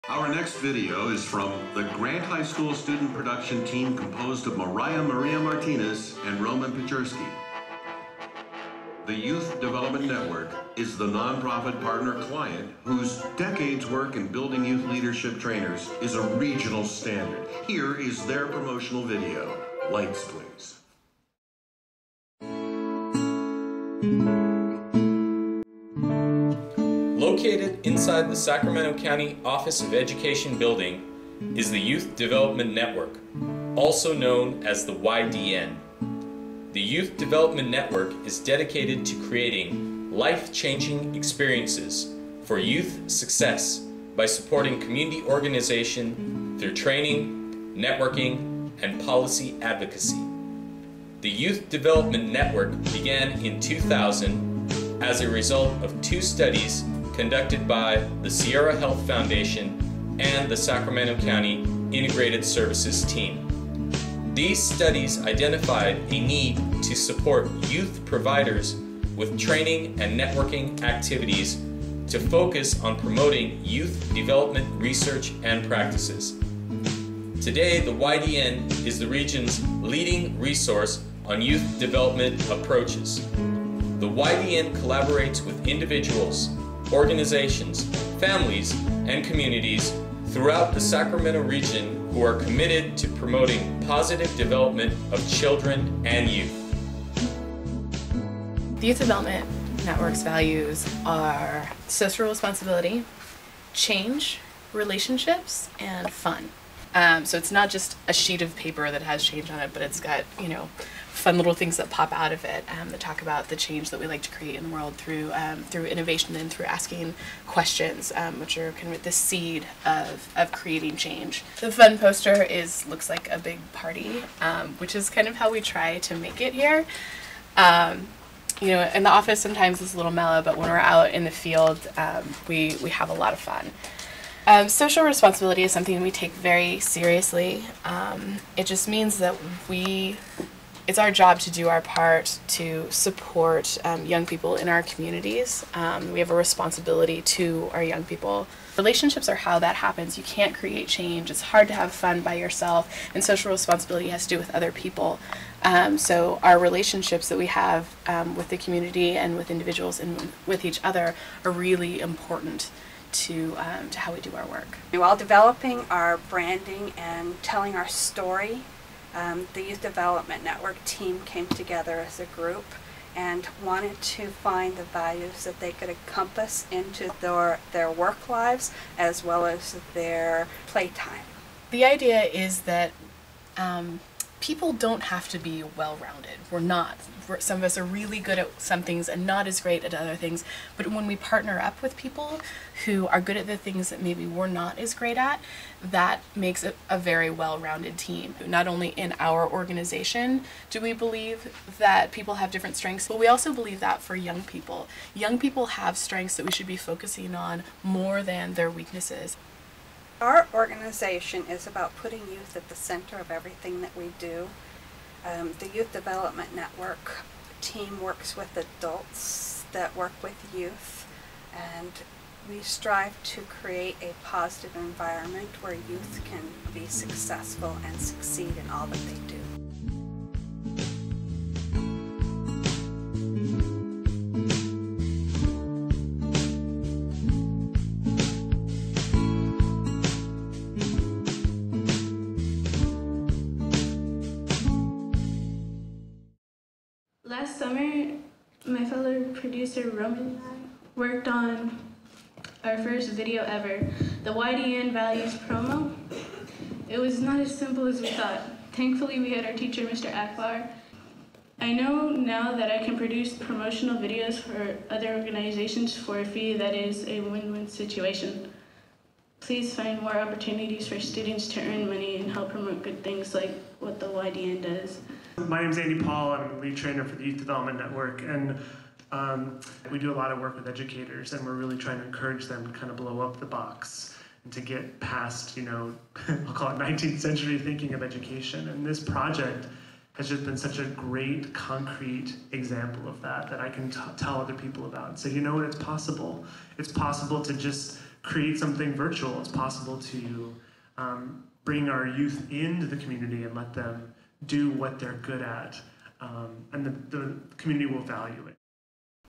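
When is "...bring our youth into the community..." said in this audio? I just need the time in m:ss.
5:01.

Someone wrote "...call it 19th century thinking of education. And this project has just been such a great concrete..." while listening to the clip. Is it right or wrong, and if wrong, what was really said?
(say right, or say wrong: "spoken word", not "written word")
right.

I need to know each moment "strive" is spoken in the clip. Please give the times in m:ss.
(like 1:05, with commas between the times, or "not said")
3:42.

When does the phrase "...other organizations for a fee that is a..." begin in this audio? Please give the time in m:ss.
4:24.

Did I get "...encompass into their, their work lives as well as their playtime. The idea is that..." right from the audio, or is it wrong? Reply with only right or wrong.
right.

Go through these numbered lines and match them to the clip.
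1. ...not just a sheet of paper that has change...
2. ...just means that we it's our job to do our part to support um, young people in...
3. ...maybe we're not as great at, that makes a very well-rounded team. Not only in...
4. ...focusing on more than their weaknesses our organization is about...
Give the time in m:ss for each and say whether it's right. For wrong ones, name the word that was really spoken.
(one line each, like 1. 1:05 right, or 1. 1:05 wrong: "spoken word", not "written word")
1. 1:47 right
2. 2:18 right
3. 3:14 right
4. 3:26 right.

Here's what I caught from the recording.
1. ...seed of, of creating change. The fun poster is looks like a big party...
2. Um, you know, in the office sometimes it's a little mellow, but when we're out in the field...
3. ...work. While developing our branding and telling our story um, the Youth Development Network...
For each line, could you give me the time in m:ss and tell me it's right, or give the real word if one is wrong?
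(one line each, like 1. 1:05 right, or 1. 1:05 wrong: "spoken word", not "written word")
1. 1:59 right
2. 2:07 right
3. 2:44 right.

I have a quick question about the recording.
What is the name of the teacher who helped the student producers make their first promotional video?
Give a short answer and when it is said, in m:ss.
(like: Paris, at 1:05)
Mr. Akbar, at 4:19.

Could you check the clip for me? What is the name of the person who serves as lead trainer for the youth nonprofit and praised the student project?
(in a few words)
Andy Paul.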